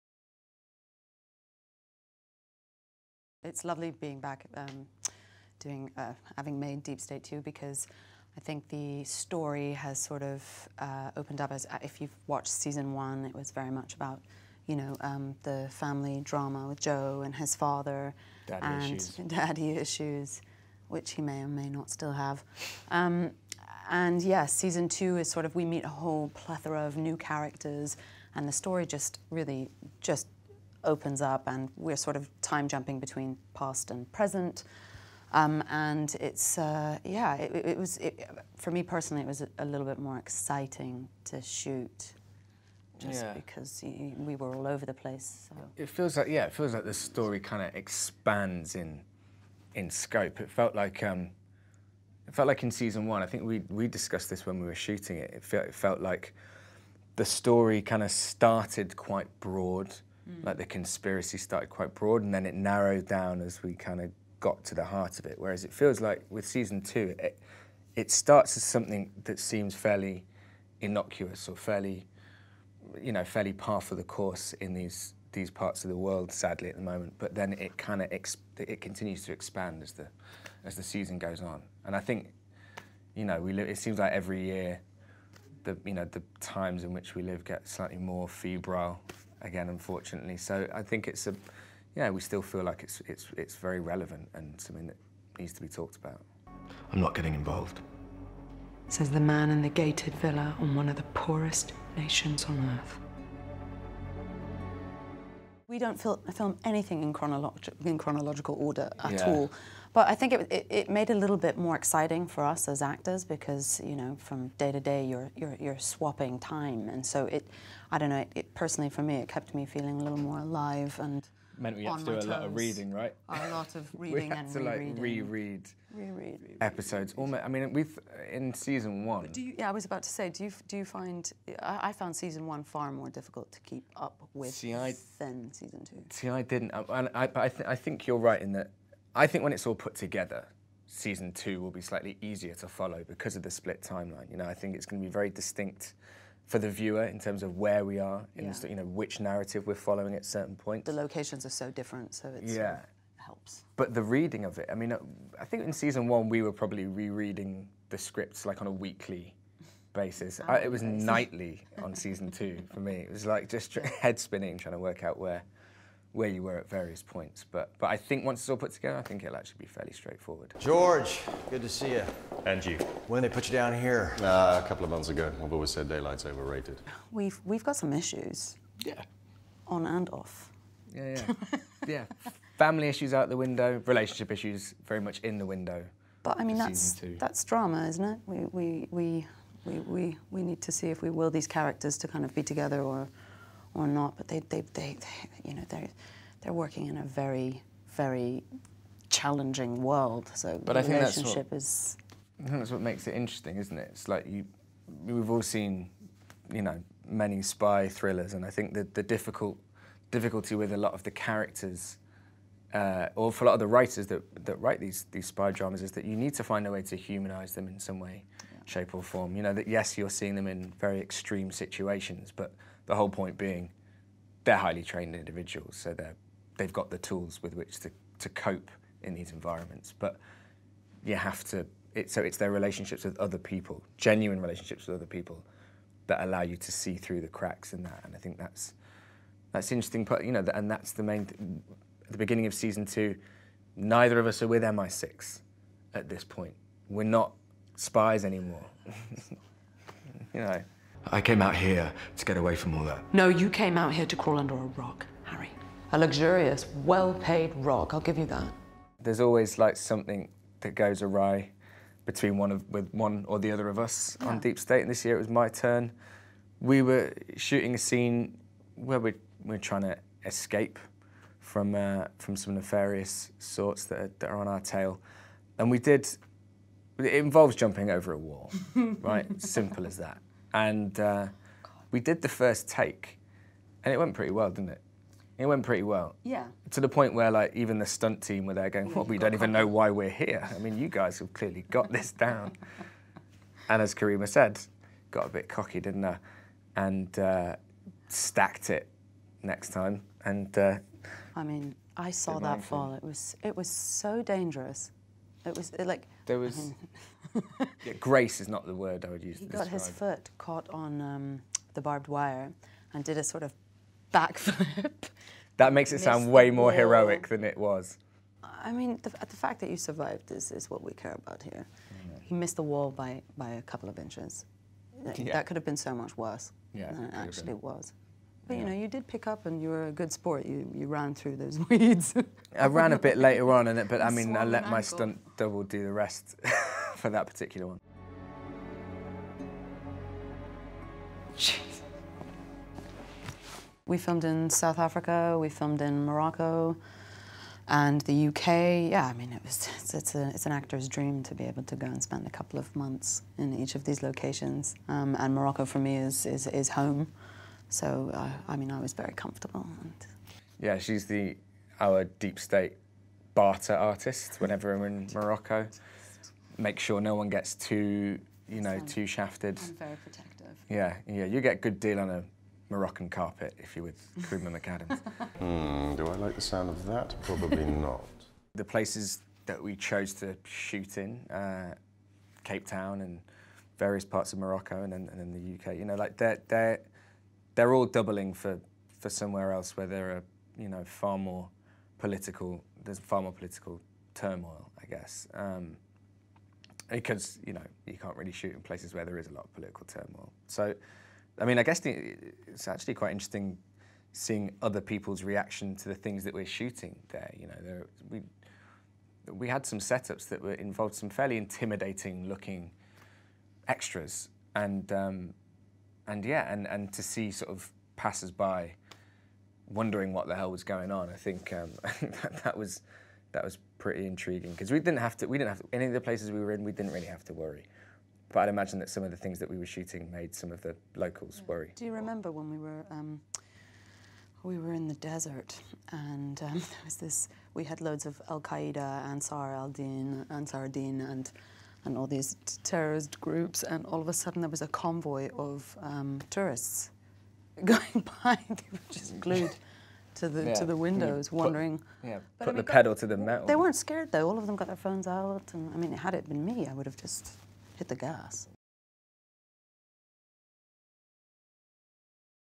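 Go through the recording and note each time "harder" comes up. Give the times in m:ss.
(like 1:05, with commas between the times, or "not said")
not said.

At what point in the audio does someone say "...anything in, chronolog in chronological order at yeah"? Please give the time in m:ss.
1:46.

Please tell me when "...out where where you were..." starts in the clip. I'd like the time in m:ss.
2:45.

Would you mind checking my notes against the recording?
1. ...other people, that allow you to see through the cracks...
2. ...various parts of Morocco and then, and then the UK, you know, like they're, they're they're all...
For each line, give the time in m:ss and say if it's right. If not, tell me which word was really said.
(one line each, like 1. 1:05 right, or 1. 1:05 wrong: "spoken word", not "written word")
1. 3:54 right
2. 6:23 right.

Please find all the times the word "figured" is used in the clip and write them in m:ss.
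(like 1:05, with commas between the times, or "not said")
not said.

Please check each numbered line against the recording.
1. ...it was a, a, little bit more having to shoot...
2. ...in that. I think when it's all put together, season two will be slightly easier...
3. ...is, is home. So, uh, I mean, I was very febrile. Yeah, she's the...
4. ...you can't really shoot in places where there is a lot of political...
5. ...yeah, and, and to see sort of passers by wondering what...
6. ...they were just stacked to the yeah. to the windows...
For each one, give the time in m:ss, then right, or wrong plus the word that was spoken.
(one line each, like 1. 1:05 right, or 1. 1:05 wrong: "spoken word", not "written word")
1. 0:39 wrong: "exciting", not "having"
2. 2:18 right
3. 5:56 wrong: "comfortable", not "febrile"
4. 6:37 right
5. 6:56 right
6. 7:28 wrong: "glued", not "stacked".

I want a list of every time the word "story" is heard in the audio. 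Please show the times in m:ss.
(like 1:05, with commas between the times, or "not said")
0:09, 0:28, 0:46, 0:57.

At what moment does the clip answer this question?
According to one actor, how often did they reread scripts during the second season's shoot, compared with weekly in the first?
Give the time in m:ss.
2:40.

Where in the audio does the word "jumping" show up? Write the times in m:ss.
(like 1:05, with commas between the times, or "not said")
0:32, 4:37.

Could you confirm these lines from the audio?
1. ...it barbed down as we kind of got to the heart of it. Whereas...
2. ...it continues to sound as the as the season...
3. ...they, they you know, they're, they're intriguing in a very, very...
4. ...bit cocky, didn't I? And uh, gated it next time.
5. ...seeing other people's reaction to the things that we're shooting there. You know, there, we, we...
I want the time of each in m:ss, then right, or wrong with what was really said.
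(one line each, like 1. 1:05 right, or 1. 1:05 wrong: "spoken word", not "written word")
1. 1:02 wrong: "narrowed", not "barbed"
2. 1:18 wrong: "expand", not "sound"
3. 3:14 wrong: "working", not "intriguing"
4. 4:55 wrong: "stacked", not "gated"
5. 6:44 right.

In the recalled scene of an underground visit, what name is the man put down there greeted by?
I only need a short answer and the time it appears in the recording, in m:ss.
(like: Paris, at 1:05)
George, at 2:50.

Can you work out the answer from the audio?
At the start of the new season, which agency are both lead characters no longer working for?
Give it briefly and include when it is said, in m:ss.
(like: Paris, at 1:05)
MI6, at 4:04.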